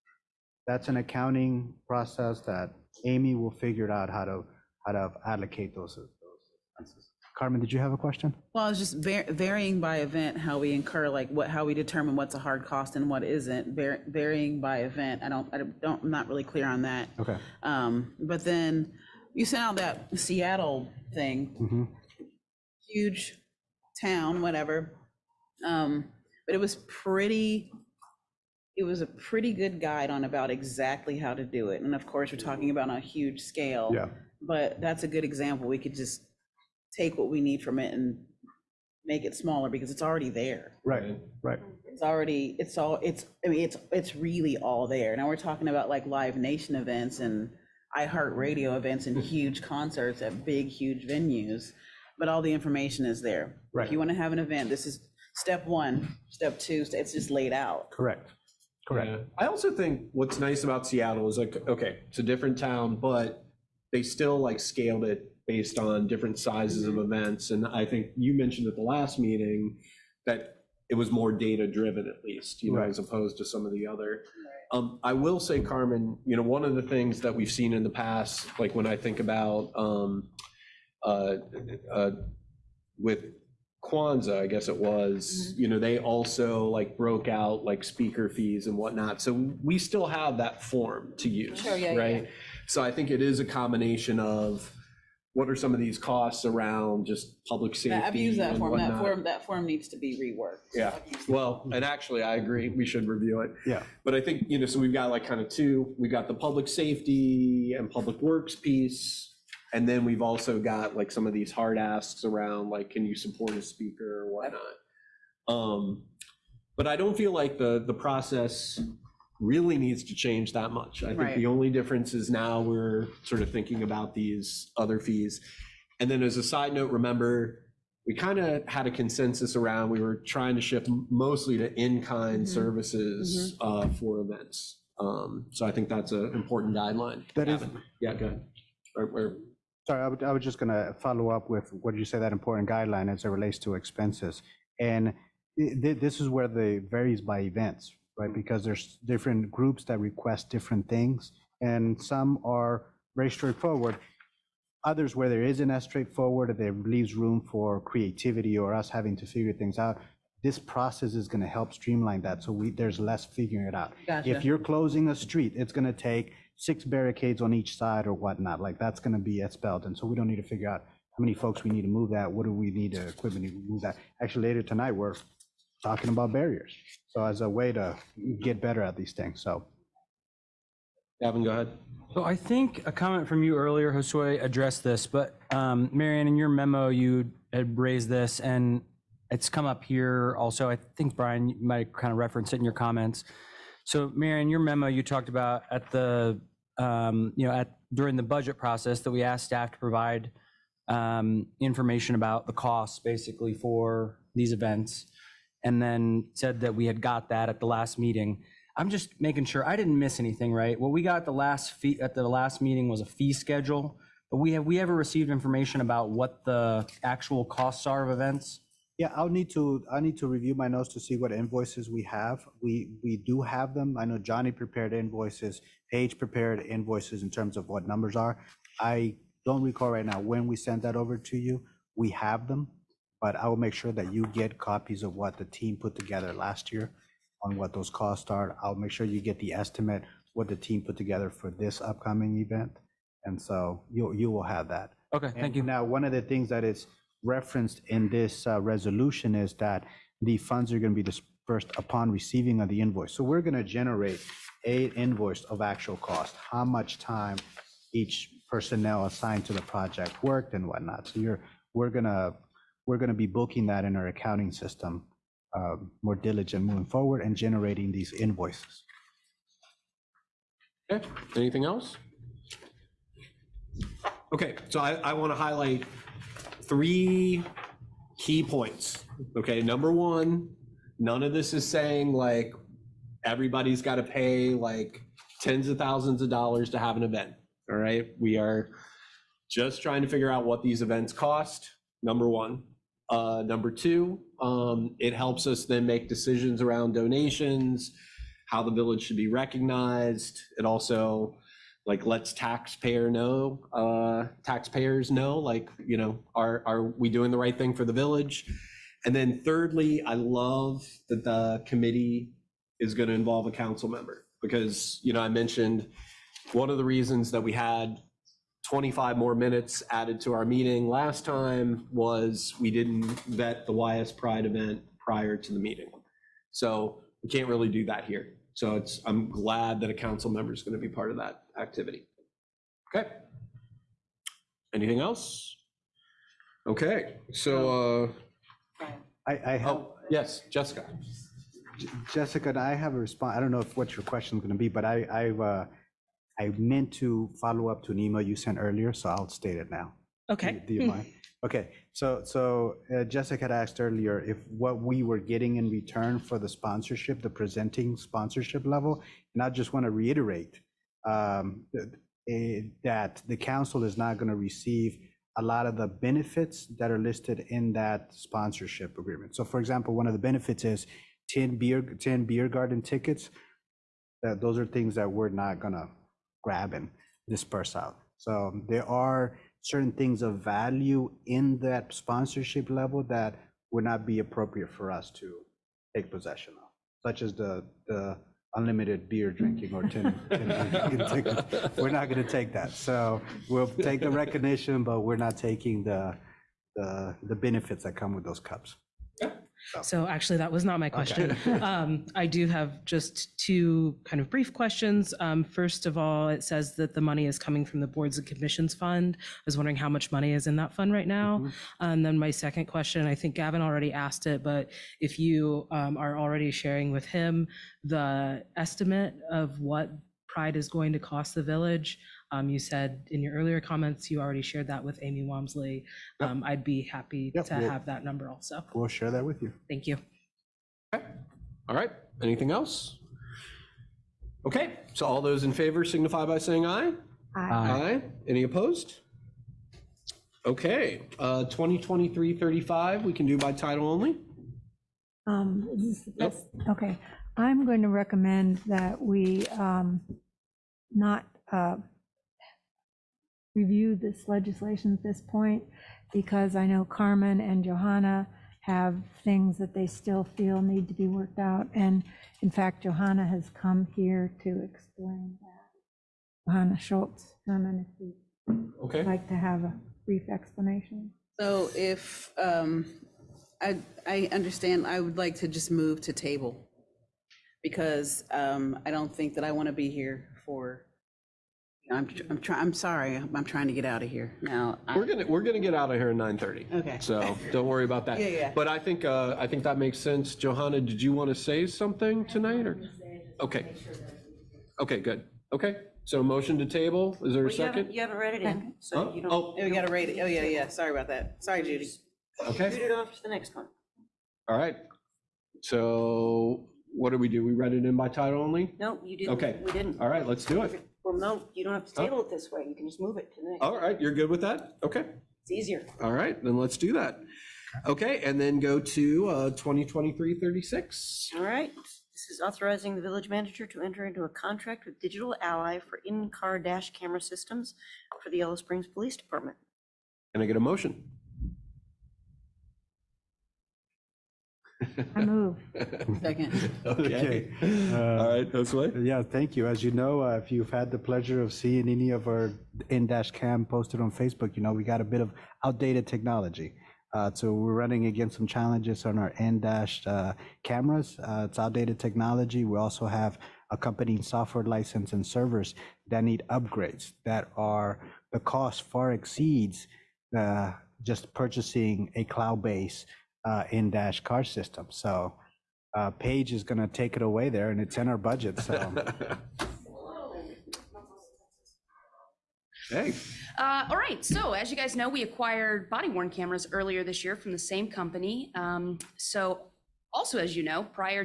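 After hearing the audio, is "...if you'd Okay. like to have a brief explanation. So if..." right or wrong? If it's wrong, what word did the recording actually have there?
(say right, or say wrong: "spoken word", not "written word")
right.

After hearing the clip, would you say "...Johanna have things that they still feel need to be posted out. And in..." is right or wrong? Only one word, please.
wrong.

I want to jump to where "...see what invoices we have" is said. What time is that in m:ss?
3:41.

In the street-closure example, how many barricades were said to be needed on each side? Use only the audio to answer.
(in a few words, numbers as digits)
6.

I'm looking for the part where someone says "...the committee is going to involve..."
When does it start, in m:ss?
5:11.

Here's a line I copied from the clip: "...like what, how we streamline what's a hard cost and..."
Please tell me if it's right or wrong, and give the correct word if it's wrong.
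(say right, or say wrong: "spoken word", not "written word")
wrong: "determine", not "streamline".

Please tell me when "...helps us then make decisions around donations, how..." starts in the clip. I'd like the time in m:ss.
4:55.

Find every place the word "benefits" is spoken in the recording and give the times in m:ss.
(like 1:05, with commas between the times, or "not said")
6:05, 6:10, 6:37.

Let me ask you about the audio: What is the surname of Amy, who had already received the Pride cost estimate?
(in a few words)
Walmsley.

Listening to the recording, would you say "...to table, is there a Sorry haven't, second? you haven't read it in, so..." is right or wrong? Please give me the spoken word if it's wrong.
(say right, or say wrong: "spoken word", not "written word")
wrong: "You", not "Sorry".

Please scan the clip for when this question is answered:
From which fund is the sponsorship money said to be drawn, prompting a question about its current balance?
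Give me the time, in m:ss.
6:47.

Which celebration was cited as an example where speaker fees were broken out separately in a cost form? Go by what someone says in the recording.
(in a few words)
Kwanzaa.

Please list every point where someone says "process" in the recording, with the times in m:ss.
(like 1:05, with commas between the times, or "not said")
0:01, 1:57, 2:40, 3:18.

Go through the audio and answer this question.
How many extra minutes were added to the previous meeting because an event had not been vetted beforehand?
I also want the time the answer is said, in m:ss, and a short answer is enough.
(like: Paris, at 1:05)
25, at 5:18.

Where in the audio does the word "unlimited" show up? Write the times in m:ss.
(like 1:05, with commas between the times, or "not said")
6:28.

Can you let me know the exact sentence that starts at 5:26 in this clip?
So we can't really do that here.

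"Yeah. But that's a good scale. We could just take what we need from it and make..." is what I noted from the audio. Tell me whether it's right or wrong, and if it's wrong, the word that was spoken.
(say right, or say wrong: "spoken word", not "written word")
wrong: "example", not "scale".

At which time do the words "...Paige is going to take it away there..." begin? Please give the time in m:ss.
9:26.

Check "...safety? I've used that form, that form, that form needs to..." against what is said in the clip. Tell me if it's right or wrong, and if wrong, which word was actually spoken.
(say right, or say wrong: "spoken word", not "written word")
right.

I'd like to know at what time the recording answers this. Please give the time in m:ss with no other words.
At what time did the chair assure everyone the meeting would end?
8:06.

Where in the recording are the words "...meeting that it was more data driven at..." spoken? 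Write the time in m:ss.
1:09.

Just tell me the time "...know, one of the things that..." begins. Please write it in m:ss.
1:16.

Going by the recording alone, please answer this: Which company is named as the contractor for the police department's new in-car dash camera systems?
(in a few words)
Digital Ally.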